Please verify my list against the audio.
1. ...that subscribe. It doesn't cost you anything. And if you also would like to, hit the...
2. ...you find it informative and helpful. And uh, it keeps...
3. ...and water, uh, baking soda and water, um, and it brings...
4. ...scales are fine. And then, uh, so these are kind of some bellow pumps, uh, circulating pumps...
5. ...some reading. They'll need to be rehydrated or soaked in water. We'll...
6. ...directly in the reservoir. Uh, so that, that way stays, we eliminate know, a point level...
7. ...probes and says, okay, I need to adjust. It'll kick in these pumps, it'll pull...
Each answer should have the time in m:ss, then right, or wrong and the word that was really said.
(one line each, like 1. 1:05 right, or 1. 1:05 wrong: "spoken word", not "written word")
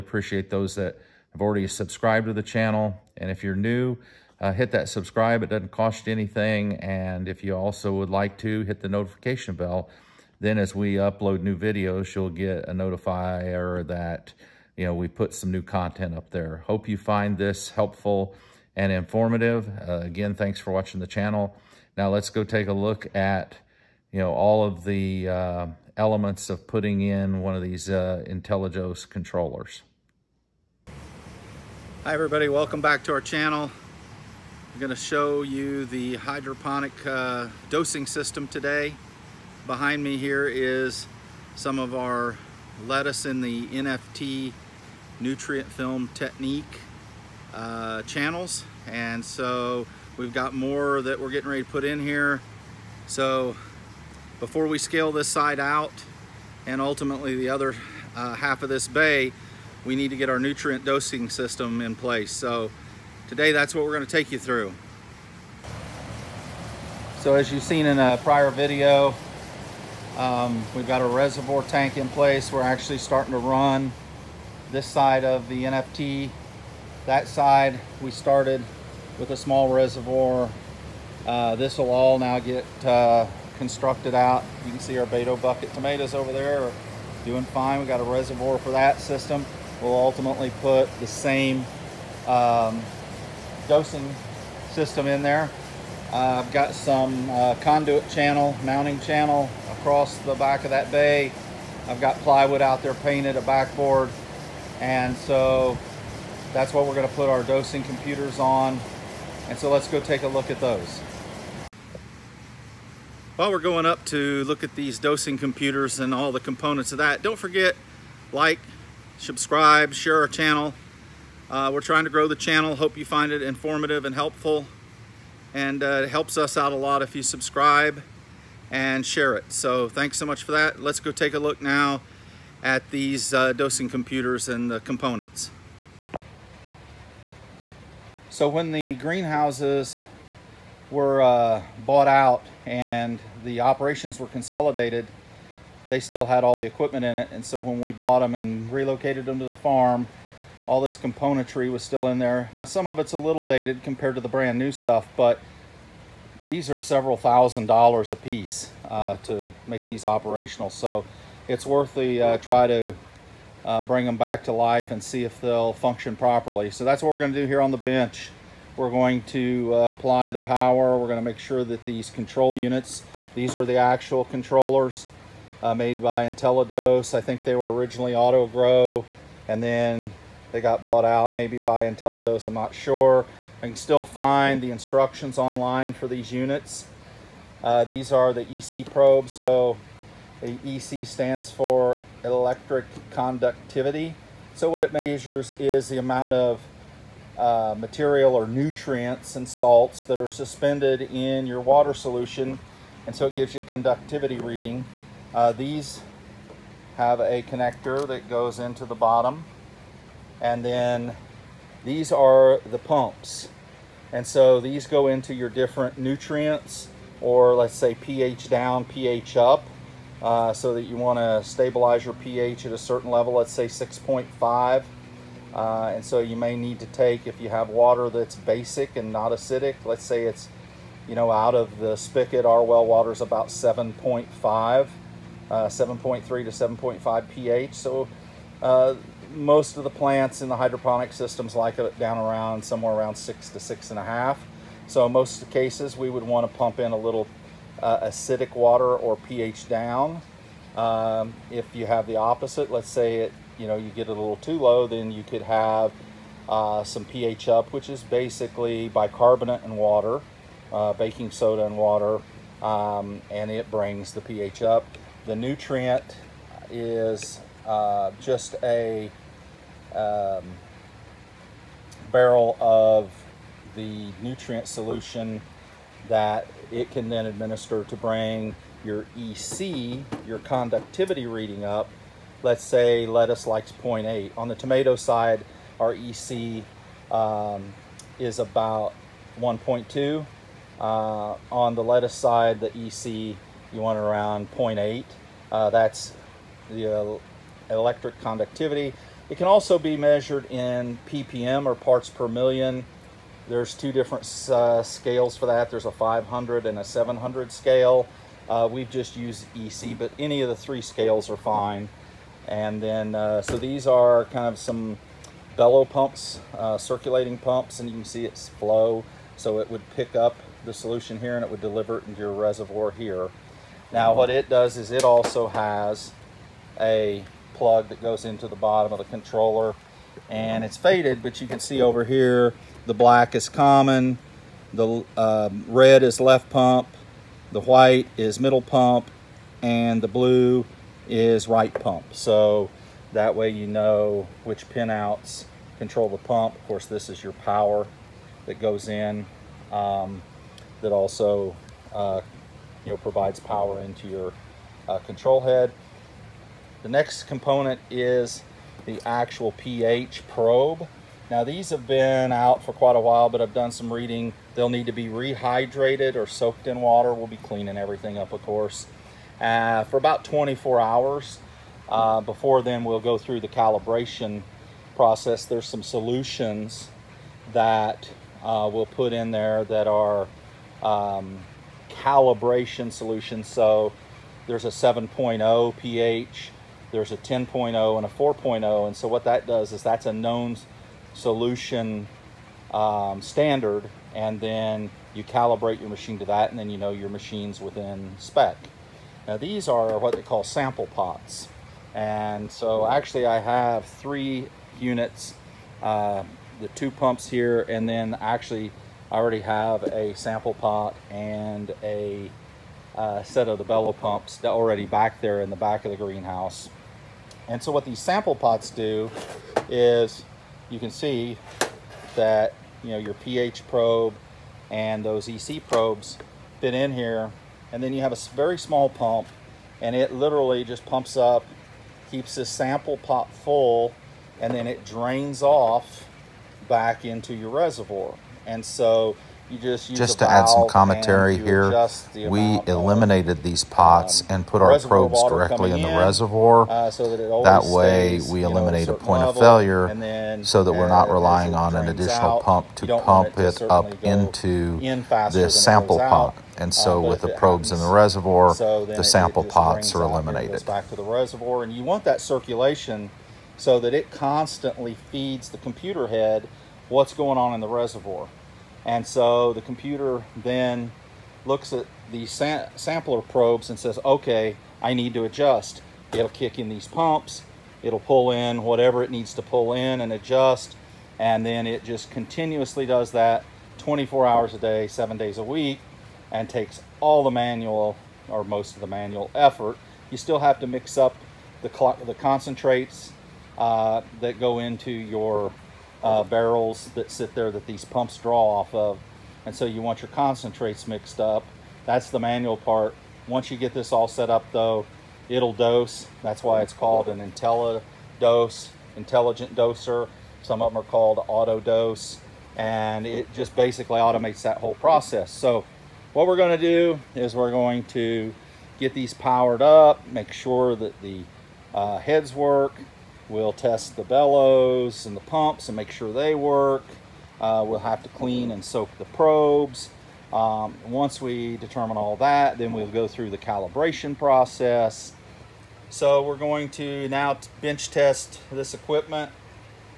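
1. 0:04 right
2. 2:02 wrong: "helps", not "keeps"
3. 4:19 right
4. 5:10 right
5. 6:03 right
6. 7:25 right
7. 7:53 right.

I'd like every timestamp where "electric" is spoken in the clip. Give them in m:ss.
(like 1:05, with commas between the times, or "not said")
3:12, 4:57.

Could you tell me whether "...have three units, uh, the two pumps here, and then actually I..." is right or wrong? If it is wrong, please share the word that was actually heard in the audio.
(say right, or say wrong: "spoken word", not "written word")
right.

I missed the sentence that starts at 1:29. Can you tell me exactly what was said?
We'll ultimately put the same um, dosing system in there.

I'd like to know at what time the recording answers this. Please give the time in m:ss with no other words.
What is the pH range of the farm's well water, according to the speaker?
3:55.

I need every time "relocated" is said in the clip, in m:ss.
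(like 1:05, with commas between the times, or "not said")
2:28.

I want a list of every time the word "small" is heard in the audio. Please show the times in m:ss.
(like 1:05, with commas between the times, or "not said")
1:19, 7:08.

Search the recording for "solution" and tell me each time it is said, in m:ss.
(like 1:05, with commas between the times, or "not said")
3:21, 4:34, 5:20, 6:15, 6:22, 6:31.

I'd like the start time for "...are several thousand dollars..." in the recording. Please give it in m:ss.
2:36.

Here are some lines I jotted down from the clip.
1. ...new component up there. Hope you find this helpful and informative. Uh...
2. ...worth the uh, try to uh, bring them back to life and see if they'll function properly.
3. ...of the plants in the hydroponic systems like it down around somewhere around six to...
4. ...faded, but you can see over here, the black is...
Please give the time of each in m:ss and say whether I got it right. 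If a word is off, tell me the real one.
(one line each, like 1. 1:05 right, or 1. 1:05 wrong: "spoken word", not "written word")
1. 0:15 wrong: "content", not "component"
2. 2:41 right
3. 3:59 right
4. 5:30 right.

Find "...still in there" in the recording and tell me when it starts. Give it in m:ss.
2:31.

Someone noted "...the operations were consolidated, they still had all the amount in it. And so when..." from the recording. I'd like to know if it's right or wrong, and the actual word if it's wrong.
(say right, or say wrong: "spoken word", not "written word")
wrong: "equipment", not "amount".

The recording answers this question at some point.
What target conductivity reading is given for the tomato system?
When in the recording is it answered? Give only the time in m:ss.
4:49.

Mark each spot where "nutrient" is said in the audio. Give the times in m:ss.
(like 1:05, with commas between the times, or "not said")
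0:45, 1:00, 3:18, 3:35, 4:25, 4:34.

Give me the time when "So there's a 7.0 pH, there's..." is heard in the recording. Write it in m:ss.
6:23.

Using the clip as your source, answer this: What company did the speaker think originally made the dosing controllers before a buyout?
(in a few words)
Autogrow.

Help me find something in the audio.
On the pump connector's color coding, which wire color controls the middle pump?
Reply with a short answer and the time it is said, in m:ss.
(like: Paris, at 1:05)
white, at 5:37.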